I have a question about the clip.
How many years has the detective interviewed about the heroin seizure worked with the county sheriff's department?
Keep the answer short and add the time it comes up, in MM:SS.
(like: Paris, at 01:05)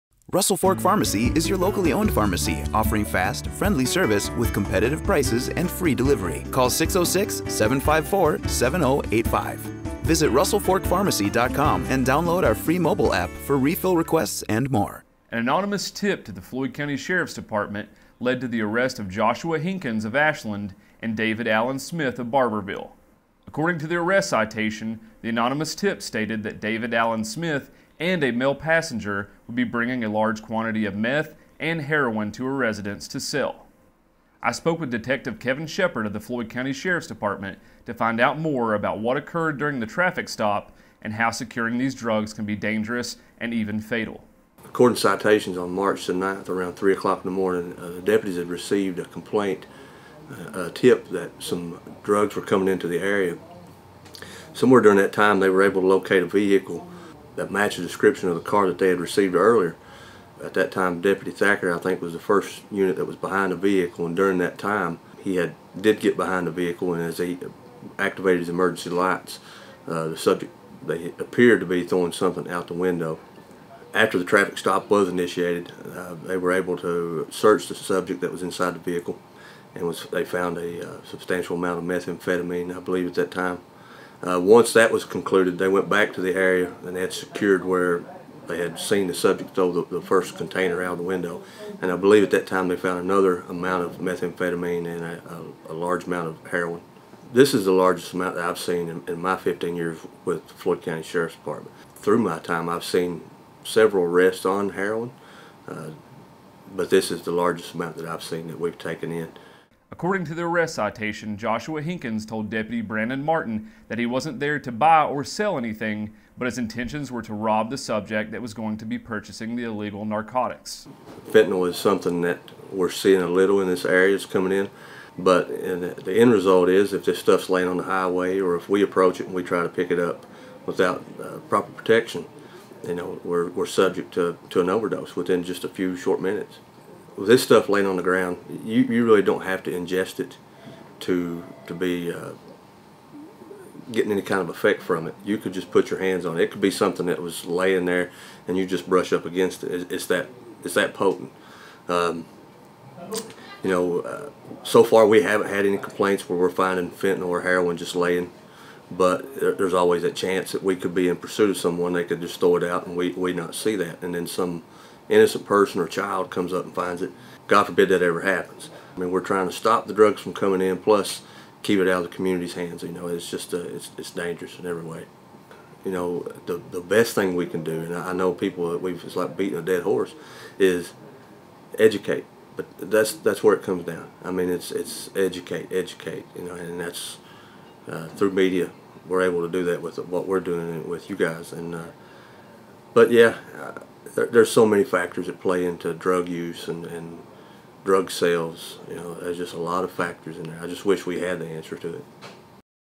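15 years, at 01:39.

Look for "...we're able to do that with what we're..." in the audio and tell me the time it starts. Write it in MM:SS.
03:09.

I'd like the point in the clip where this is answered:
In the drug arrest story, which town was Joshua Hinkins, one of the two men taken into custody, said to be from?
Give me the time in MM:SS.
00:20.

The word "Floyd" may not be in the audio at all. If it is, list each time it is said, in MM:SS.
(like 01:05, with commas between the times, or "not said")
00:16, 00:36, 01:40.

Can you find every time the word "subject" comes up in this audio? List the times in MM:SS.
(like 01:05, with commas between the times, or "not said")
01:10, 01:17, 01:29, 01:57, 02:13.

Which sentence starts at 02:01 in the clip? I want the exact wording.
Fentanyl is something that we're seeing a little in this area, it's coming in.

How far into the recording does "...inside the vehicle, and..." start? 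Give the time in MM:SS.
01:18.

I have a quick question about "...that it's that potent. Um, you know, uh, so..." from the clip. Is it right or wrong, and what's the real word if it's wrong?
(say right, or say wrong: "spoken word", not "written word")
right.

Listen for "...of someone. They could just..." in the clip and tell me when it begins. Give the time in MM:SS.
02:41.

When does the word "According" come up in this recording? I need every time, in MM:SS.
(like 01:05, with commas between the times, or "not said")
00:23, 00:44, 01:49.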